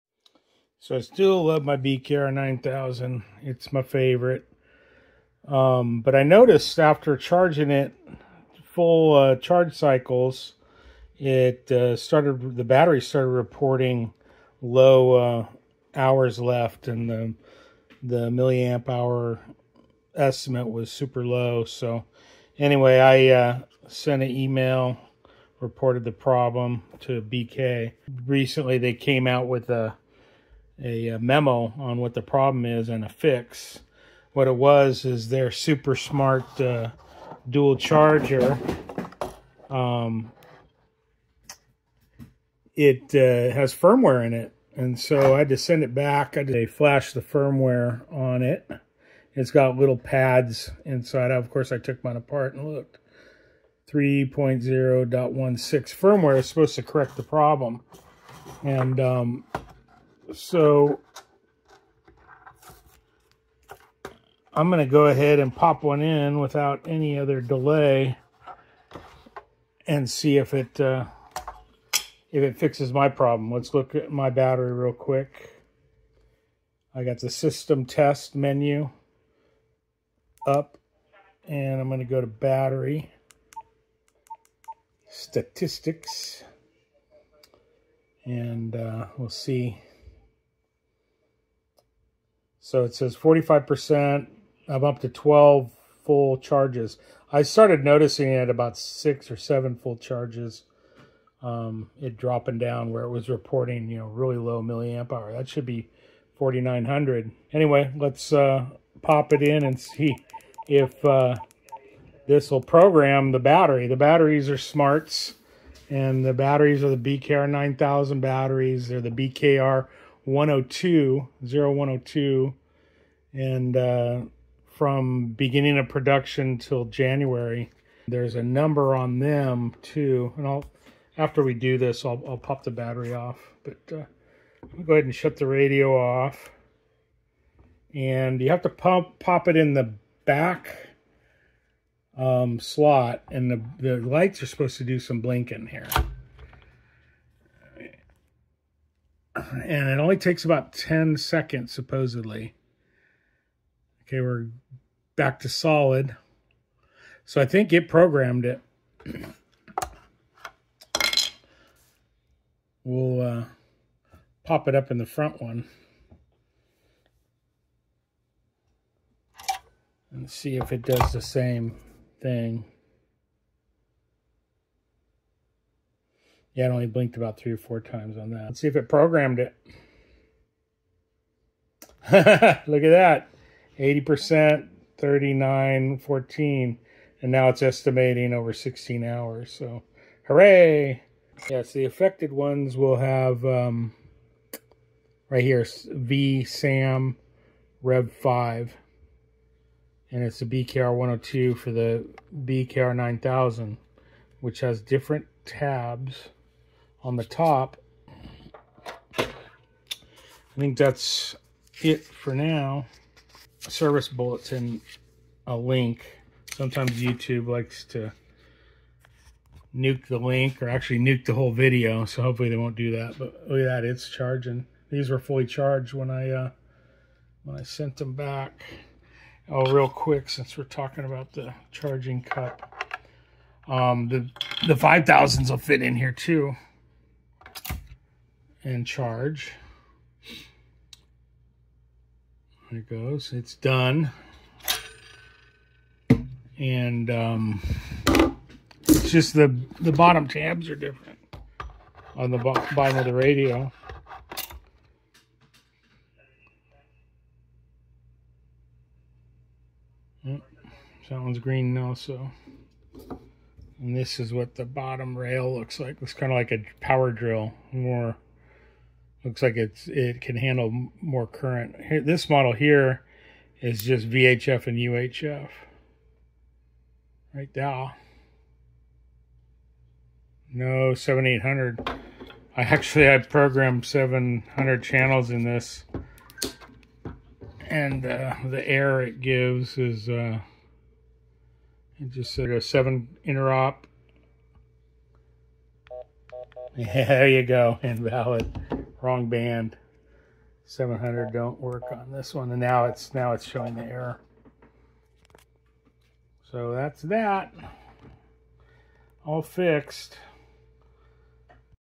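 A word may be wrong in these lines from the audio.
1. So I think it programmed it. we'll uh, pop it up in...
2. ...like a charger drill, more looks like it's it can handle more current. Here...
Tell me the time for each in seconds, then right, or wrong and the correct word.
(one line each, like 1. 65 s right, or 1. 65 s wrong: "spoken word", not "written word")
1. 157 s right
2. 266 s wrong: "power", not "charger".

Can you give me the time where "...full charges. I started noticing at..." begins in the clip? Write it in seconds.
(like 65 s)
96 s.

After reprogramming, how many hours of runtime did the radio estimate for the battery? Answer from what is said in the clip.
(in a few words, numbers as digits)
over 16 hours.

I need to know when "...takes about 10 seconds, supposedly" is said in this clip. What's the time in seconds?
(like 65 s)
150 s.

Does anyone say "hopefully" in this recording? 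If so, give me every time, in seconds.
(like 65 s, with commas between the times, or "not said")
222 s.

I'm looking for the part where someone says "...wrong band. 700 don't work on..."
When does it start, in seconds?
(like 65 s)
299 s.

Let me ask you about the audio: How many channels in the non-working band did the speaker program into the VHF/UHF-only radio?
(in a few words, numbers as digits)
700.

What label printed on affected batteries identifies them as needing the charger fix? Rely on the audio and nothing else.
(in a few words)
V SAM Rev 5.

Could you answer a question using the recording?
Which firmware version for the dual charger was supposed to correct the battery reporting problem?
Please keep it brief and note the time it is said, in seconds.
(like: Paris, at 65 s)
3.0.16, at 53 s.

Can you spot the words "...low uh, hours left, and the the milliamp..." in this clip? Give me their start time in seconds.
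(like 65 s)
14 s.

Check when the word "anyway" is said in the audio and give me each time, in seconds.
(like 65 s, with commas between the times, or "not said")
22 s, 107 s.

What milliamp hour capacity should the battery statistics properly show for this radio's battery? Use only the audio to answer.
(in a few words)
4,900.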